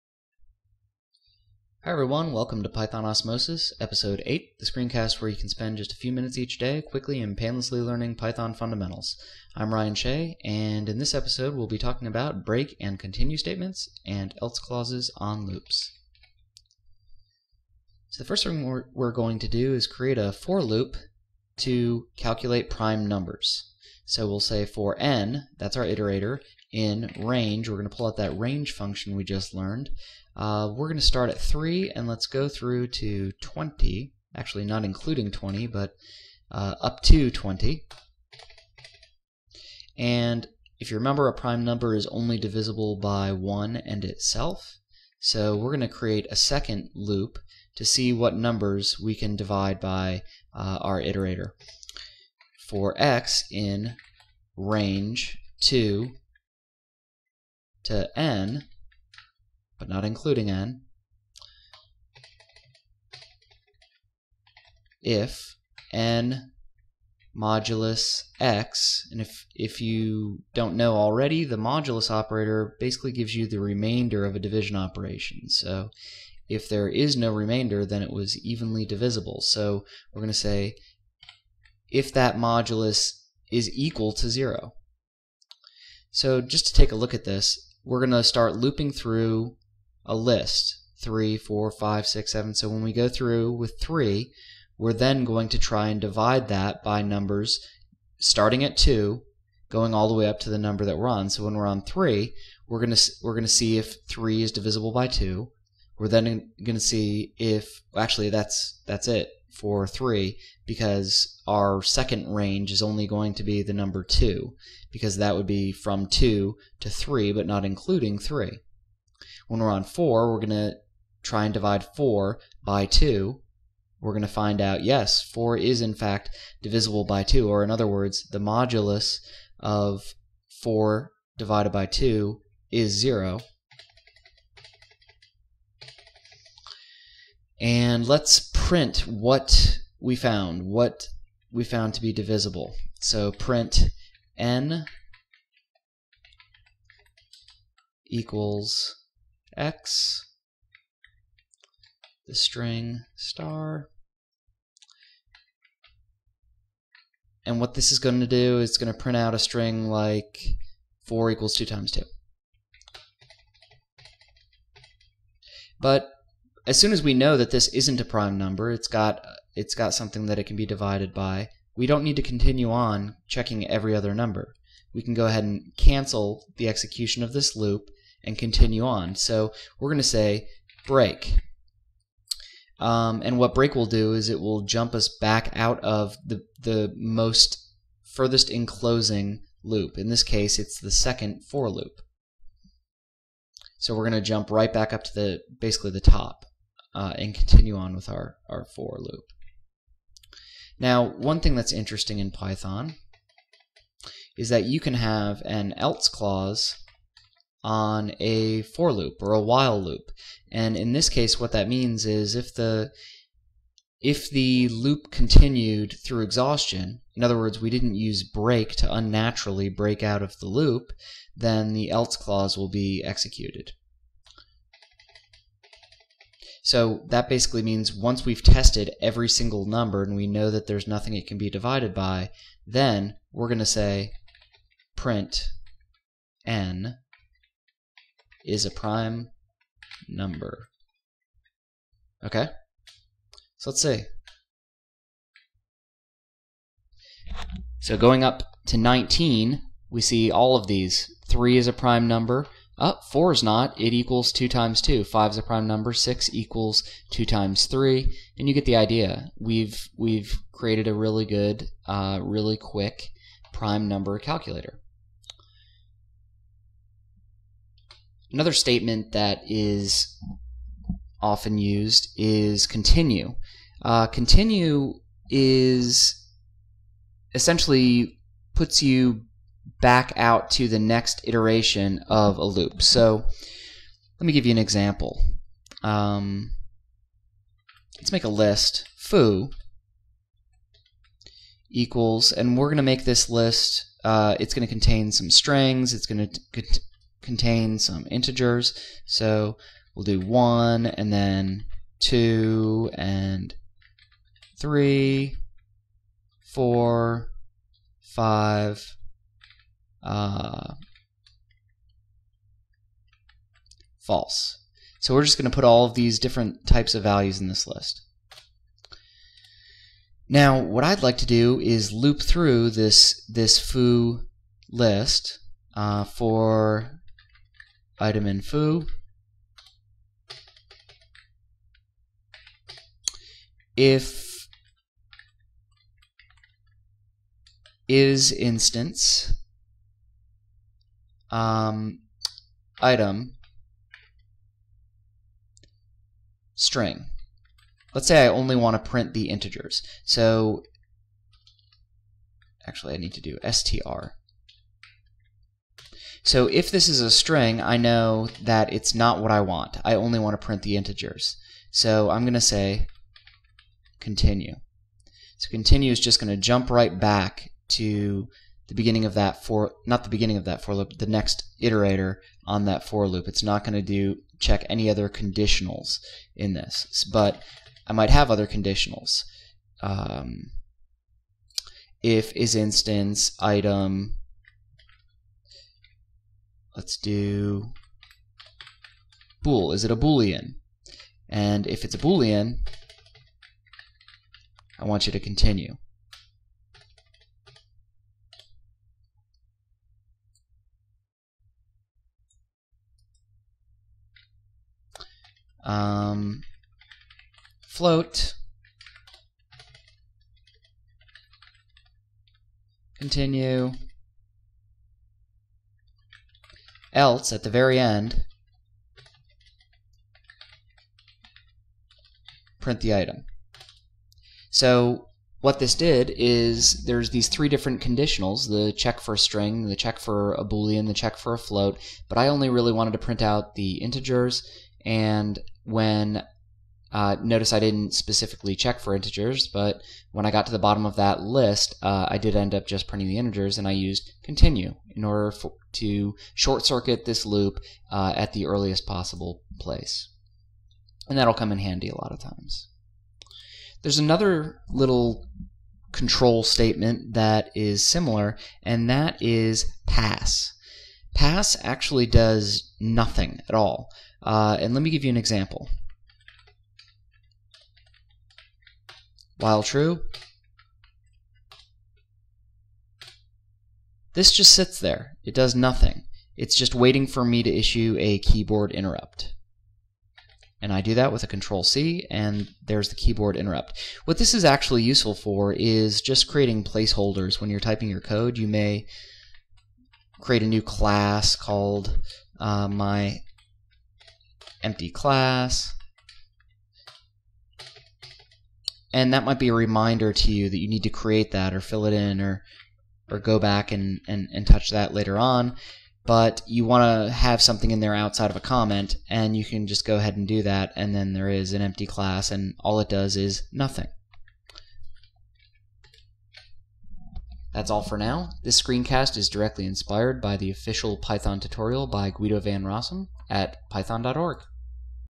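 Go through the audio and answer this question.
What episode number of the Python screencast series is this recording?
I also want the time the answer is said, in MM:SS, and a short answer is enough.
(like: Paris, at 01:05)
8, at 00:03.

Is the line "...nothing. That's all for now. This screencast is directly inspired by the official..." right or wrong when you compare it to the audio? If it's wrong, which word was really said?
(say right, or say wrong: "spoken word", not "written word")
right.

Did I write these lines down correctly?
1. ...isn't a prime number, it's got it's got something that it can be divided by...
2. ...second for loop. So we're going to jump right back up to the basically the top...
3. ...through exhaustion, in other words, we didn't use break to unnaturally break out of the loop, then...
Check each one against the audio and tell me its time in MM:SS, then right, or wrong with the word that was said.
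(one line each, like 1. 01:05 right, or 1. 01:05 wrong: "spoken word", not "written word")
1. 02:47 right
2. 03:10 right
3. 03:36 right.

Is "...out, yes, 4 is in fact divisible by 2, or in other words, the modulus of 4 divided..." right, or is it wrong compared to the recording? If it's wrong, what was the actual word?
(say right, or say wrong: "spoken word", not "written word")
right.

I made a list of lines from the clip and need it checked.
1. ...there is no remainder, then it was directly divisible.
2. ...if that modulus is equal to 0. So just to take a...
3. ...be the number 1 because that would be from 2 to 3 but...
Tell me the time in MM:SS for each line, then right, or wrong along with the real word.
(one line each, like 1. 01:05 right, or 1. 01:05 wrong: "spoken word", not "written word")
1. 01:16 wrong: "evenly", not "directly"
2. 01:21 right
3. 01:53 wrong: "2", not "1".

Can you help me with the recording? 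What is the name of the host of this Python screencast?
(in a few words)
Ryan Shea.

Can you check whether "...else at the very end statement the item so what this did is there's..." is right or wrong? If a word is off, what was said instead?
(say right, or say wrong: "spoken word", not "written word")
wrong: "print", not "statement".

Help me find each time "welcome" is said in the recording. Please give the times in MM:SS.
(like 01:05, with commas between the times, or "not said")
00:02.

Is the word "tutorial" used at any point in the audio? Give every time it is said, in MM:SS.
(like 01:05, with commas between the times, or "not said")
08:41.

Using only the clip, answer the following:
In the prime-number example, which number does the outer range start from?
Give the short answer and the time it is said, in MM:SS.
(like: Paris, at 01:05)
3, at 00:31.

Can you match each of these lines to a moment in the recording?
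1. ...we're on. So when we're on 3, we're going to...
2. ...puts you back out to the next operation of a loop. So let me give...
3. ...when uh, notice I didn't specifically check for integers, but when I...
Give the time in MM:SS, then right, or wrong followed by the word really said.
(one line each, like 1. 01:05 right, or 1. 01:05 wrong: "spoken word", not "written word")
1. 01:40 right
2. 04:38 wrong: "iteration", not "operation"
3. 07:15 right.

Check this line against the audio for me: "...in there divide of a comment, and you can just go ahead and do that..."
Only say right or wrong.
wrong.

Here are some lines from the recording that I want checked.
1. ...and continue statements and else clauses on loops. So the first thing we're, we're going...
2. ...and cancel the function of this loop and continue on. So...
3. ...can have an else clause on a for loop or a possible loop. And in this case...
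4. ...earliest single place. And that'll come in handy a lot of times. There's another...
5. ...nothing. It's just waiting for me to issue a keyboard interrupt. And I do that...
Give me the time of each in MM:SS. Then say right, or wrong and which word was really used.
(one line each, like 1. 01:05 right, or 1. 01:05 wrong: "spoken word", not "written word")
1. 00:12 right
2. 02:55 wrong: "execution", not "function"
3. 03:24 wrong: "while", not "possible"
4. 07:28 wrong: "possible", not "single"
5. 07:55 right.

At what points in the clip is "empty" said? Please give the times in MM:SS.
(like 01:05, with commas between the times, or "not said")
08:14, 08:31.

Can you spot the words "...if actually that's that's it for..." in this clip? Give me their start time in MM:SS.
01:47.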